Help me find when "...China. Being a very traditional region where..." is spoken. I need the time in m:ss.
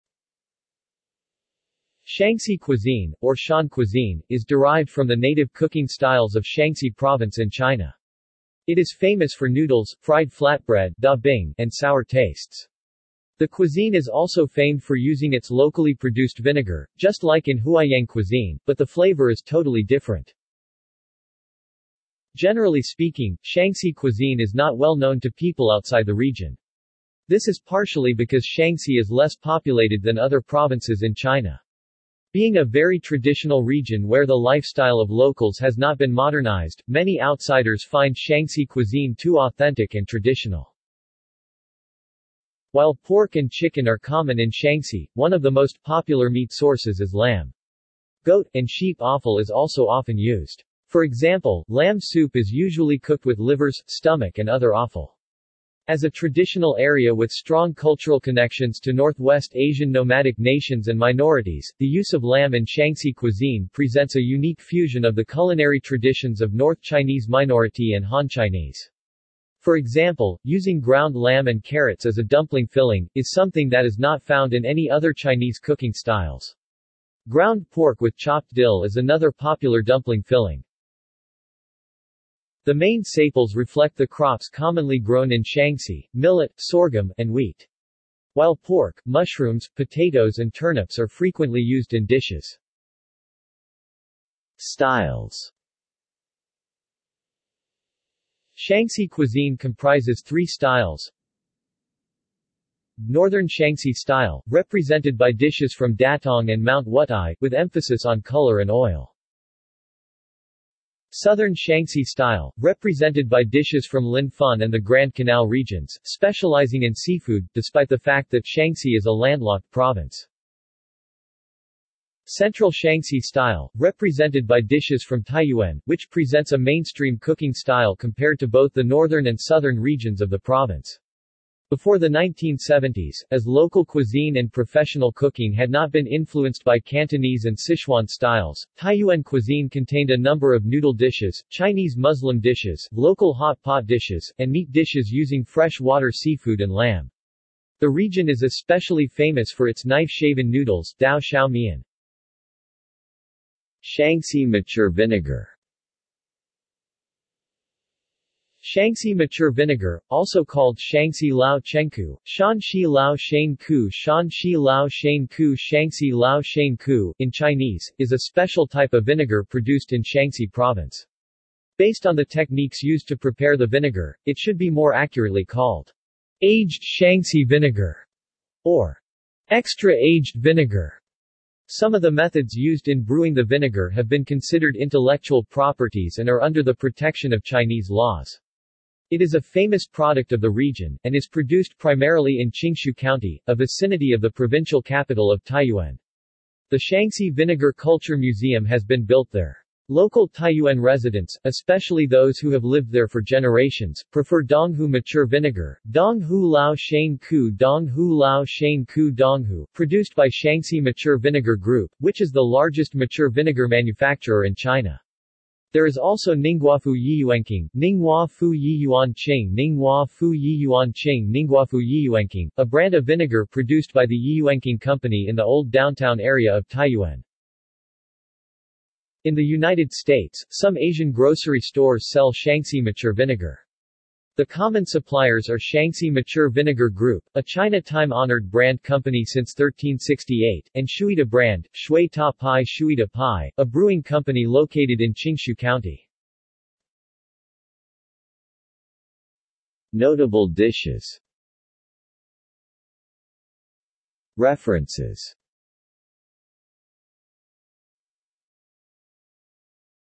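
0:31.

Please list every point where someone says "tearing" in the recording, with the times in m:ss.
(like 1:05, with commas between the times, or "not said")
not said.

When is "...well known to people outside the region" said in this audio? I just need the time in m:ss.
0:24.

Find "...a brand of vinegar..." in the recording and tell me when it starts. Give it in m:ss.
3:42.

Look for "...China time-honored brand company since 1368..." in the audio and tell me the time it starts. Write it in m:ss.
3:57.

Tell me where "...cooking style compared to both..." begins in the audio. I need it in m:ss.
2:07.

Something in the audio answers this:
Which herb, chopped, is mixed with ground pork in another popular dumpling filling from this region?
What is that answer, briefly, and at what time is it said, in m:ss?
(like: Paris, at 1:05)
dill, at 1:18.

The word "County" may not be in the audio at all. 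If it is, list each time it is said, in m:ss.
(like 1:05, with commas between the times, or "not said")
3:12, 4:05.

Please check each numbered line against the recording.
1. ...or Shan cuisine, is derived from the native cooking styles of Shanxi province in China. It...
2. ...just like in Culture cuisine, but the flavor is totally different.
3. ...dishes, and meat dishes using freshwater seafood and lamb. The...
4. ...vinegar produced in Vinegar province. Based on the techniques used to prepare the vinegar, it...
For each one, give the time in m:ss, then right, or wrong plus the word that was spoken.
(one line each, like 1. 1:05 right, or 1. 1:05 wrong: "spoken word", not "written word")
1. 0:03 right
2. 0:16 wrong: "Huaiyang", not "Culture"
3. 2:23 right
4. 2:49 wrong: "Shanxi", not "Vinegar".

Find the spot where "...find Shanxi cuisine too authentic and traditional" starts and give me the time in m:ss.
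0:37.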